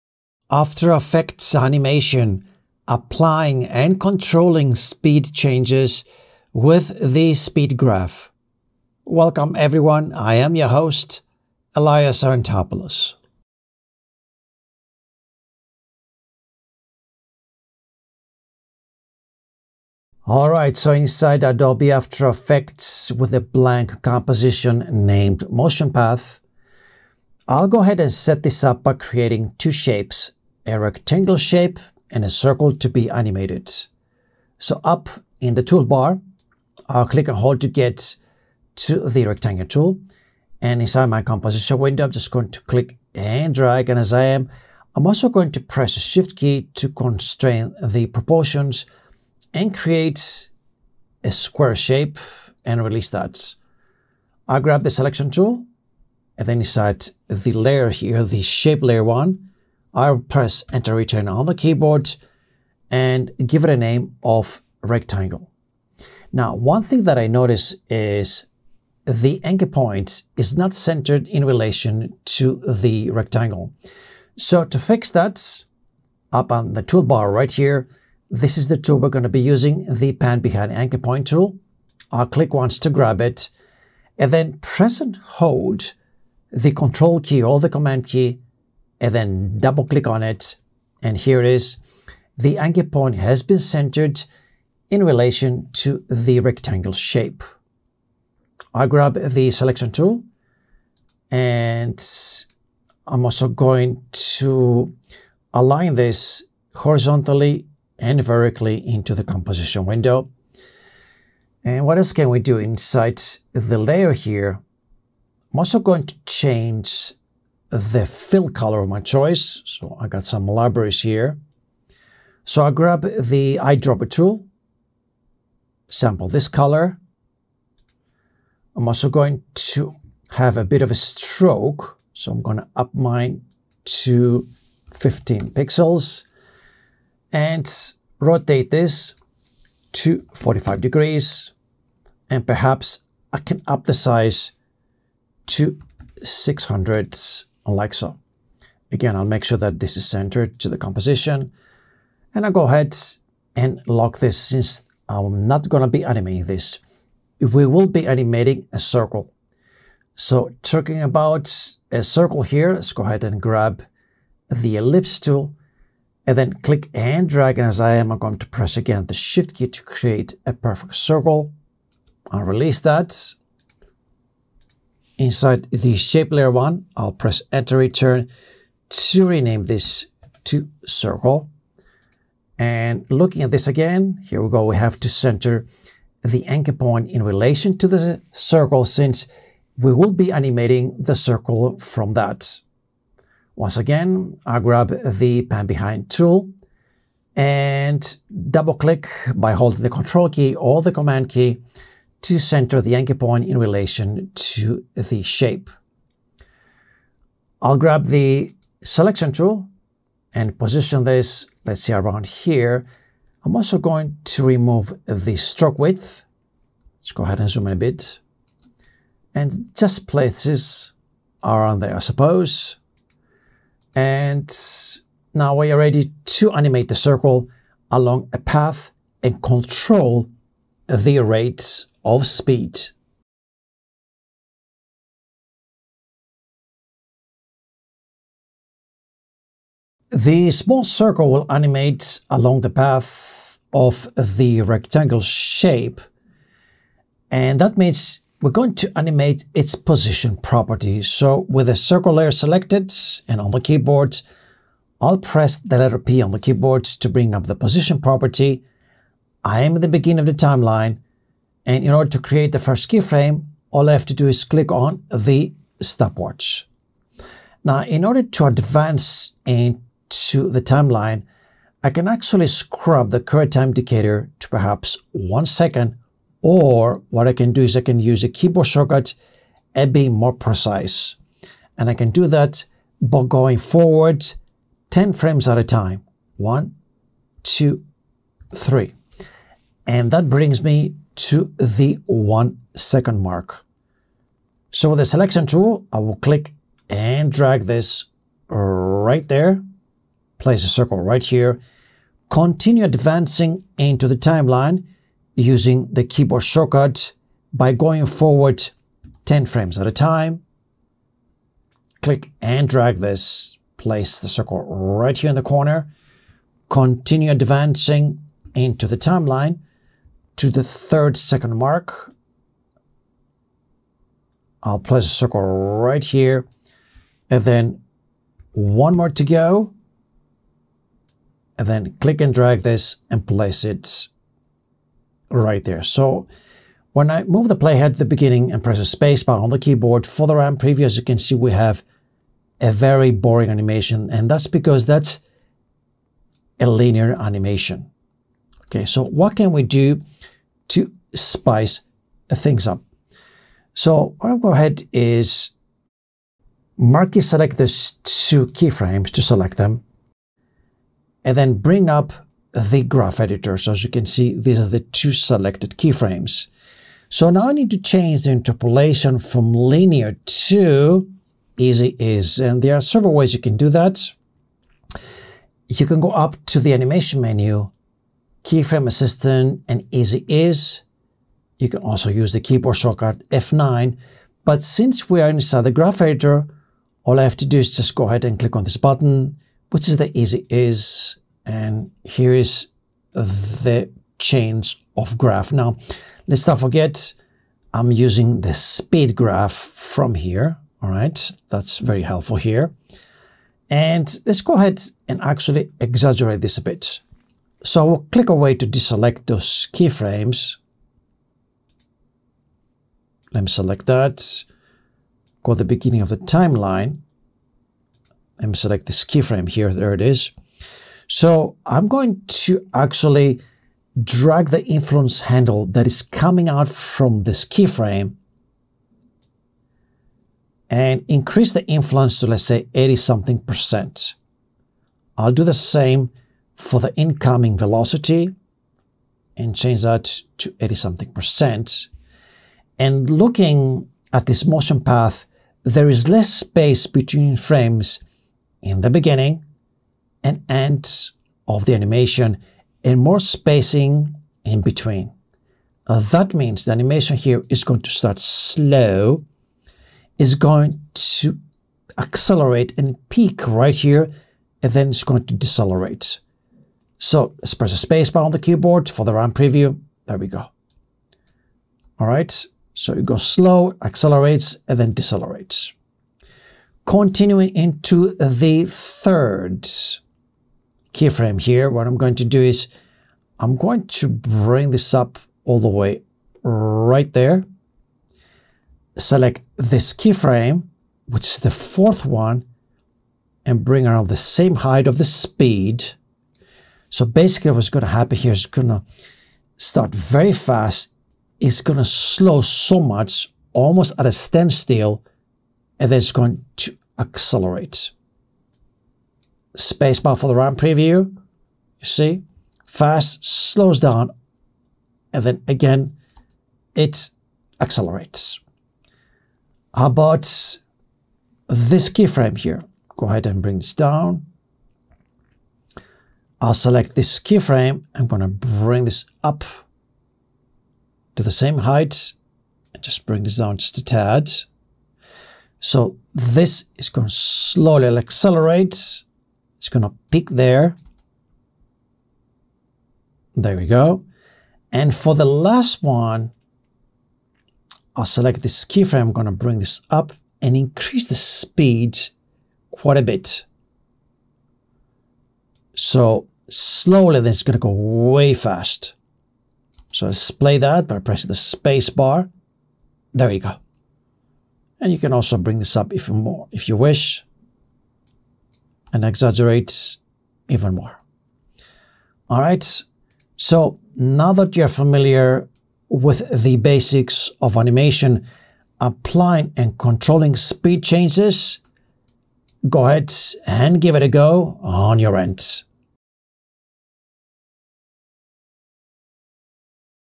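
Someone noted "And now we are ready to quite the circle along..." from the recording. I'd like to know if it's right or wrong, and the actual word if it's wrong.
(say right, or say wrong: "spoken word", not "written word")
wrong: "animate", not "quite".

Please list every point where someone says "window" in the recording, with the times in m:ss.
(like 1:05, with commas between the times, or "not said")
0:41, 1:49.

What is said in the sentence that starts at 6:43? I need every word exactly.
And let's go ahead and actually exaggerate this a bit.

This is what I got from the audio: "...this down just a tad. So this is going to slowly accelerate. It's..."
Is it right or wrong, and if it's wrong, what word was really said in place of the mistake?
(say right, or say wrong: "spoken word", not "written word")
right.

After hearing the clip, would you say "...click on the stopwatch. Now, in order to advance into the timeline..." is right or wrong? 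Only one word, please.
right.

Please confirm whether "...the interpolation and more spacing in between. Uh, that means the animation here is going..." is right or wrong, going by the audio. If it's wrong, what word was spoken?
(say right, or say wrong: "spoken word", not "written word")
wrong: "animation", not "interpolation".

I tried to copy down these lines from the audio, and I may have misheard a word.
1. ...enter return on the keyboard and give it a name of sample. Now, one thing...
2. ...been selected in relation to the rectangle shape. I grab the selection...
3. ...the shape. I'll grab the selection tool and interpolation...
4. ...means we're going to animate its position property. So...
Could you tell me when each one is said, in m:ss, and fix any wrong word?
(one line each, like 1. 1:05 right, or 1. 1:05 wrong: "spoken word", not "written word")
1. 1:00 wrong: "rectangle", not "sample"
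2. 1:33 wrong: "centered", not "selected"
3. 3:24 wrong: "position", not "interpolation"
4. 4:07 right.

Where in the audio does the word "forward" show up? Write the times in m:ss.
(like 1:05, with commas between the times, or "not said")
4:43, 5:08.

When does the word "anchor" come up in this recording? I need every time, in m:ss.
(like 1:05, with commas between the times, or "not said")
1:09, 1:20, 1:32, 3:06, 3:22.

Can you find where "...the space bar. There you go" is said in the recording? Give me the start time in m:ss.
9:21.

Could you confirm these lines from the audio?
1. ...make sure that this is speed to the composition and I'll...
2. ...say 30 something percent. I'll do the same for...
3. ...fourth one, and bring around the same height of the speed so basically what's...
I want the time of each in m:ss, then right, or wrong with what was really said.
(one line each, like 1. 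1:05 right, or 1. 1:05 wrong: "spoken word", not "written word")
1. 2:29 wrong: "centered", not "speed"
2. 7:12 wrong: "80", not "30"
3. 8:11 right.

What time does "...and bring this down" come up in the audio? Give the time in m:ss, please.
8:43.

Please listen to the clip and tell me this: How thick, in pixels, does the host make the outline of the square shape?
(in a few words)
15 pixels.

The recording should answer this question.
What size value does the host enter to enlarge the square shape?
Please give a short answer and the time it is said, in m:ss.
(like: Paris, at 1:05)
600, at 2:26.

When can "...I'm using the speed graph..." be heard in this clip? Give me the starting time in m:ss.
6:37.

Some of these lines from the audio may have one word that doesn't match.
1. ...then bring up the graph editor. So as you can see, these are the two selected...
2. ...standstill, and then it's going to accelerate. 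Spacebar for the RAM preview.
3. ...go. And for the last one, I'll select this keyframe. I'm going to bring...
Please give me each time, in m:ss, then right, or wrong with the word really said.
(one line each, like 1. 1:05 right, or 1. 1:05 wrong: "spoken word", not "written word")
1. 6:01 right
2. 8:24 right
3. 9:03 right.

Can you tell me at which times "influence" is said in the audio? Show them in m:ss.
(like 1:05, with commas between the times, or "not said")
7:04, 7:11.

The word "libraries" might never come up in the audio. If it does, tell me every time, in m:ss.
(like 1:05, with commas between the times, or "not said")
2:00.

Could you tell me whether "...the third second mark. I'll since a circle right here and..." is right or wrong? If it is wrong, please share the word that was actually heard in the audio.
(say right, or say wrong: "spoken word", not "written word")
wrong: "place", not "since".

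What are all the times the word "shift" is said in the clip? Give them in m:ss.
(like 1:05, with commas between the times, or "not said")
0:46, 2:49.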